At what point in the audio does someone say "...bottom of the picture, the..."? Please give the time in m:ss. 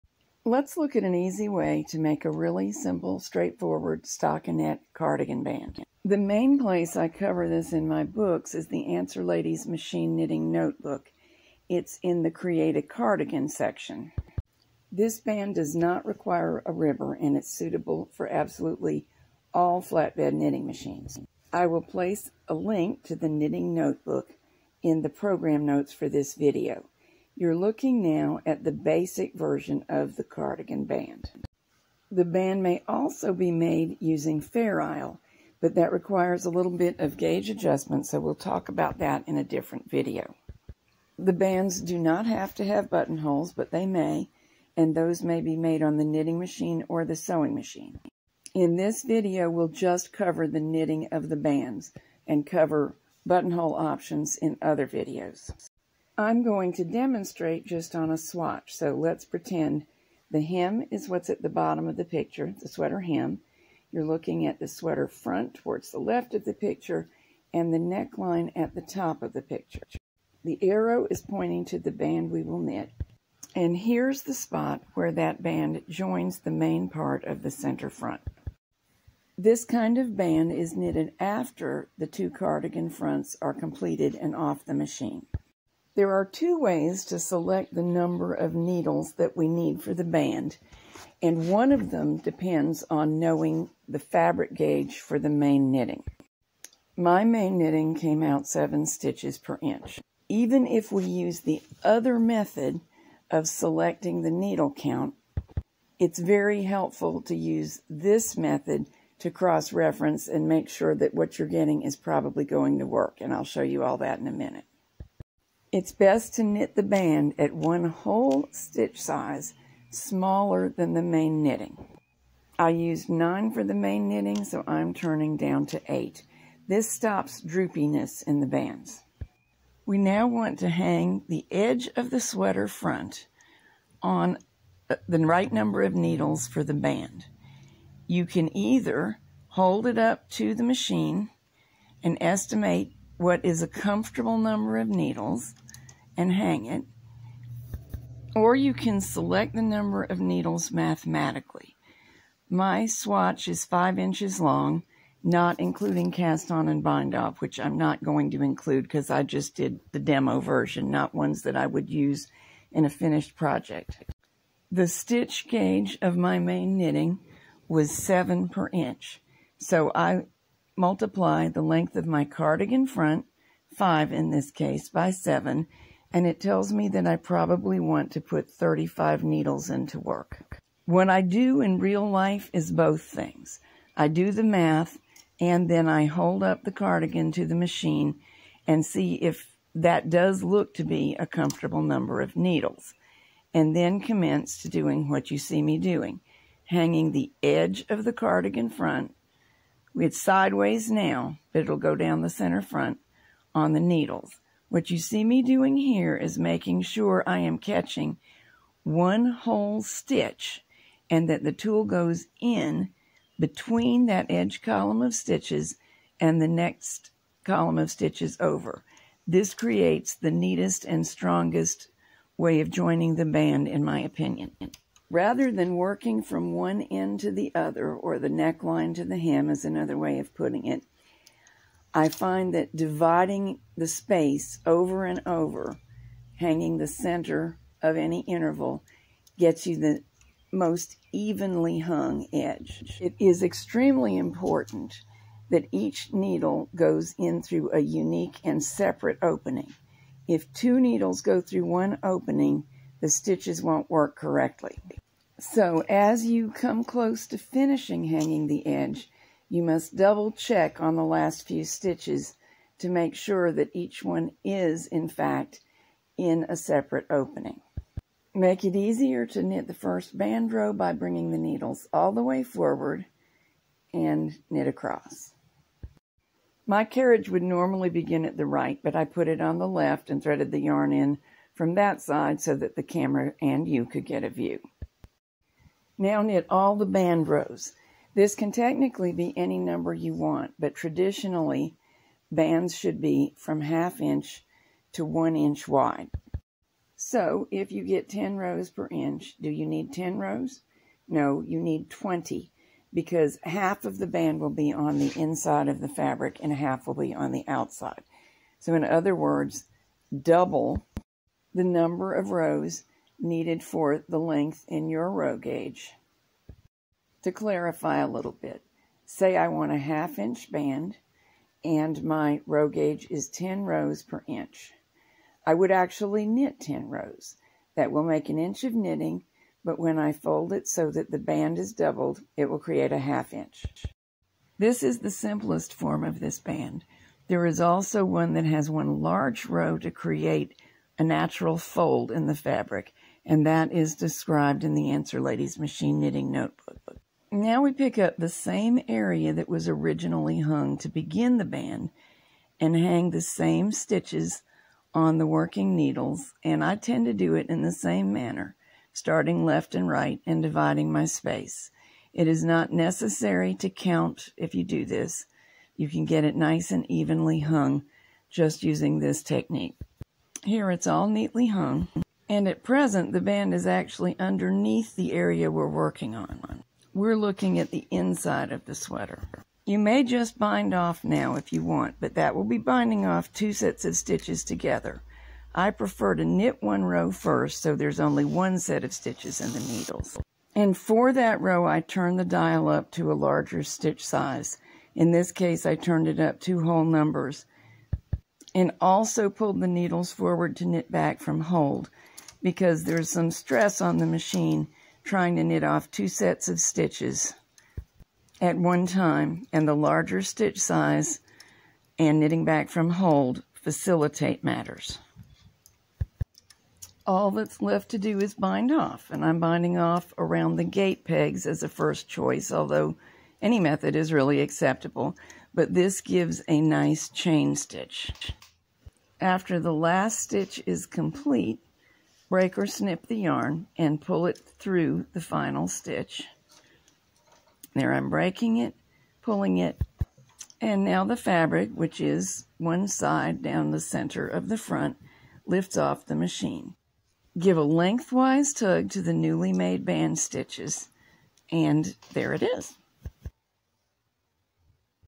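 1:01.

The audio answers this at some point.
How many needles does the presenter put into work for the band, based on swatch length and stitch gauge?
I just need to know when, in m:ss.
2:58.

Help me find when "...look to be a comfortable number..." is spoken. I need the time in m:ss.
3:10.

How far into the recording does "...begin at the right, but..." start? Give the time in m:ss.
4:37.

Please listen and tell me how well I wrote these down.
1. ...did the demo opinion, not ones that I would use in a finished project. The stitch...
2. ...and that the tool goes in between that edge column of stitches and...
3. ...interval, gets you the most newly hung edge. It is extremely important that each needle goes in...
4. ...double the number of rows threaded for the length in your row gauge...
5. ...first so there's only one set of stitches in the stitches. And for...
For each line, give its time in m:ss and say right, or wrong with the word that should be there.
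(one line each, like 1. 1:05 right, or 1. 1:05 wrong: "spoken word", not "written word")
1. 2:39 wrong: "version", not "opinion"
2. 3:31 right
3. 3:58 wrong: "evenly", not "newly"
4. 5:10 wrong: "needed", not "threaded"
5. 6:27 wrong: "needles", not "stitches".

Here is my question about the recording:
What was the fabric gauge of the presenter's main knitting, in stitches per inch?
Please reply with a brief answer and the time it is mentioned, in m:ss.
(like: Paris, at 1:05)
7 stitches per inch, at 1:38.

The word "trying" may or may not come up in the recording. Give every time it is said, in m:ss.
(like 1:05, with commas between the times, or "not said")
6:45.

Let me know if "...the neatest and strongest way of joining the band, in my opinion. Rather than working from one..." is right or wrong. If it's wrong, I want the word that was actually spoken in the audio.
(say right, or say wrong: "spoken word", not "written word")
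right.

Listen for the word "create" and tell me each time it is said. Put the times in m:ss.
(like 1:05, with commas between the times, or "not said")
0:12, 3:39, 5:32, 5:39.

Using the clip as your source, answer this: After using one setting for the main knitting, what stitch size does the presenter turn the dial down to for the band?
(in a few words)
8.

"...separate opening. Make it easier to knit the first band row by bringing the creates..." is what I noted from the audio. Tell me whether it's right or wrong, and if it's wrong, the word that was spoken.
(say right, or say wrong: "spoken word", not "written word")
wrong: "needles", not "creates".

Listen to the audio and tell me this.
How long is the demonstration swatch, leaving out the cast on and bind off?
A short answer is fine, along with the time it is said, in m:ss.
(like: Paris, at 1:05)
5 inches, at 2:33.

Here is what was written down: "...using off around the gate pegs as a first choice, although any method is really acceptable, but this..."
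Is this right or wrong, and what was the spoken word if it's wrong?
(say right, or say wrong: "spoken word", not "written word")
wrong: "binding", not "using".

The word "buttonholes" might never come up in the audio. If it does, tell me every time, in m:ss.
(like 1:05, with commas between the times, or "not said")
0:42, 0:53.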